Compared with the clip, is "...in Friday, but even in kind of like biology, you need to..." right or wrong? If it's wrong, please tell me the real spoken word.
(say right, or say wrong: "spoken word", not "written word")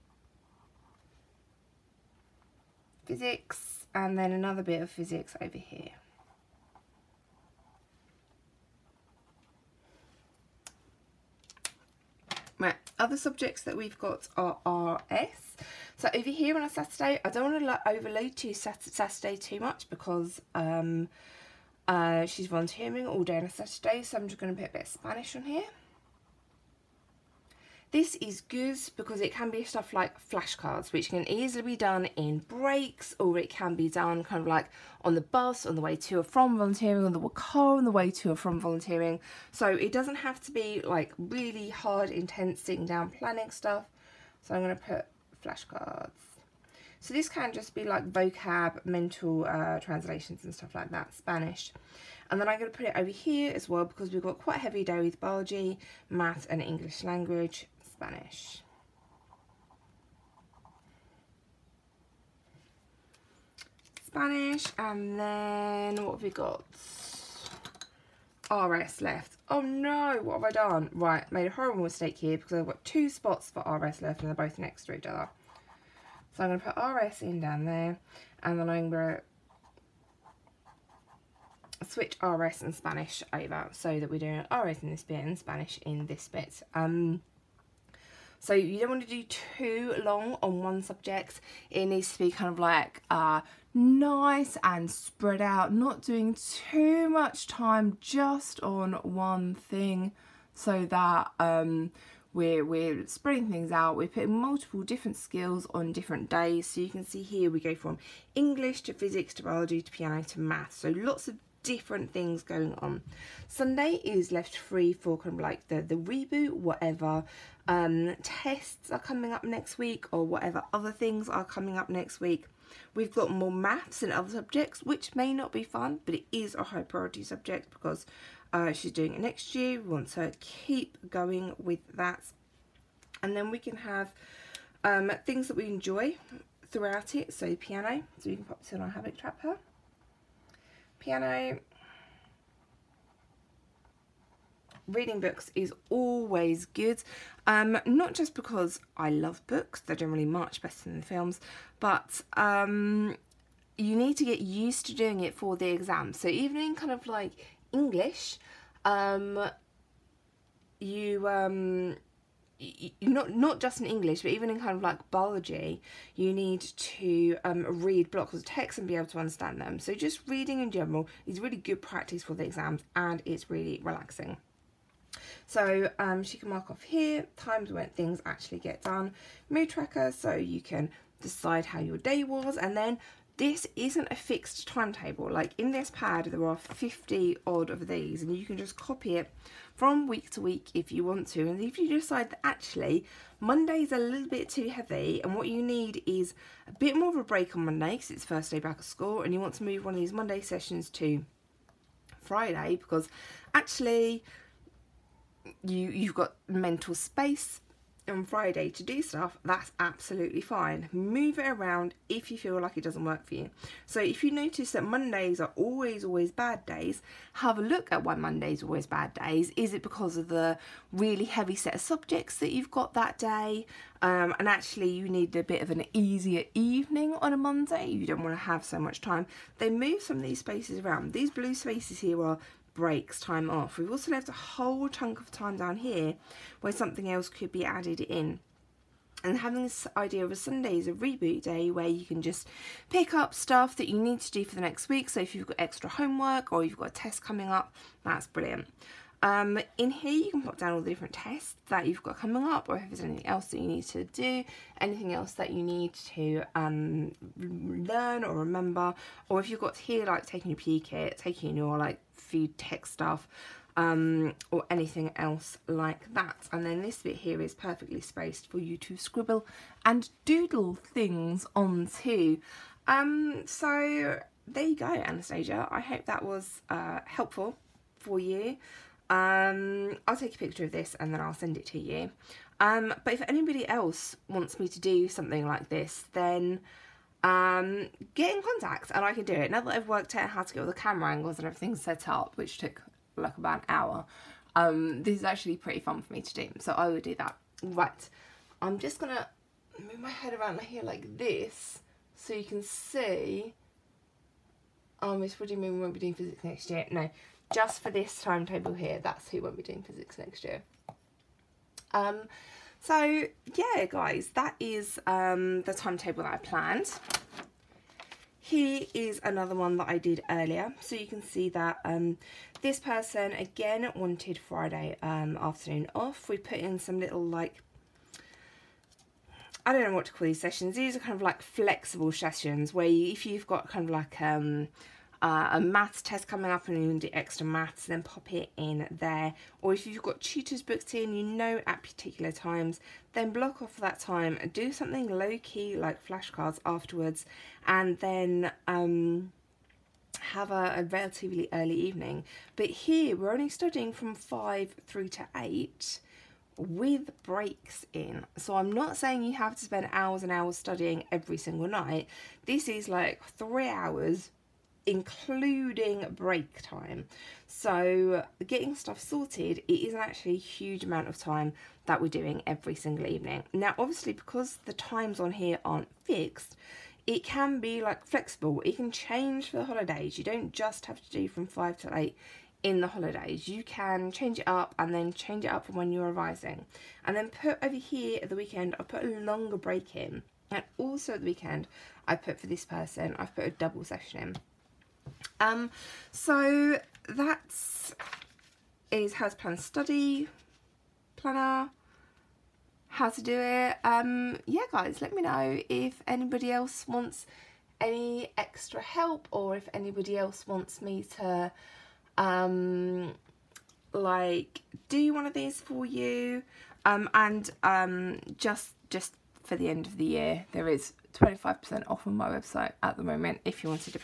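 wrong: "English", not "Friday".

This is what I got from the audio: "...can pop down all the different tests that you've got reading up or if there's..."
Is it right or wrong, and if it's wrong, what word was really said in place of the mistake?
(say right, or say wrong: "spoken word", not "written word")
wrong: "coming", not "reading".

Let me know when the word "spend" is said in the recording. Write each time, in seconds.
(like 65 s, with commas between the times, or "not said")
359 s.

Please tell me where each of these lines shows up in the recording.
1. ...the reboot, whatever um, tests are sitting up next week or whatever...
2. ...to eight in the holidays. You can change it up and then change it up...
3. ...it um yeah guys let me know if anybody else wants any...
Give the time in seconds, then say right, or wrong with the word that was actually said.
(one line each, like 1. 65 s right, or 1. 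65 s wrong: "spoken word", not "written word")
1. 115 s wrong: "coming", not "sitting"
2. 381 s right
3. 403 s right.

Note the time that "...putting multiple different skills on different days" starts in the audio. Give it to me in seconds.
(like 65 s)
104 s.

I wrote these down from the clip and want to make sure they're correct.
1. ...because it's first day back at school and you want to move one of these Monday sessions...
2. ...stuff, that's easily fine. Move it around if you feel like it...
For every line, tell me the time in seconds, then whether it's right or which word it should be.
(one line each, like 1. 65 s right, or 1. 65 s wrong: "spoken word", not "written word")
1. 197 s right
2. 209 s wrong: "absolutely", not "easily".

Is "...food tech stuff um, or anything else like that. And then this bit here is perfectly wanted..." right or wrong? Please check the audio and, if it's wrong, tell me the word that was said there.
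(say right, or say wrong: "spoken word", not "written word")
wrong: "spaced", not "wanted".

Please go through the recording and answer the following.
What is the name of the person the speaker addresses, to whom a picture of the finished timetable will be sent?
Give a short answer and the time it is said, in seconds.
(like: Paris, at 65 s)
Anastasia, at 274 s.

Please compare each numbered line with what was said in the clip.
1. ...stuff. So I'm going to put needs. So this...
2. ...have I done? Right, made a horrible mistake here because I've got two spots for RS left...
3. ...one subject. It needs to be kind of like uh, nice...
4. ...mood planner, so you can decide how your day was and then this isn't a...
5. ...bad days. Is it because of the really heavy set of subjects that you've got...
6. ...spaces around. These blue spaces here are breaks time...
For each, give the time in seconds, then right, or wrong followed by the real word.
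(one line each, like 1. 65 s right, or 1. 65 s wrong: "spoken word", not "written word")
1. 43 s wrong: "flashcards", not "needs"
2. 70 s right
3. 90 s right
4. 179 s wrong: "tracker", not "planner"
5. 218 s right
6. 230 s right.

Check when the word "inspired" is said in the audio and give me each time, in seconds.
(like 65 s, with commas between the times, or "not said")
not said.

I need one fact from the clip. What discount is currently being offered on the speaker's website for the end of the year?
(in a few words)
25%.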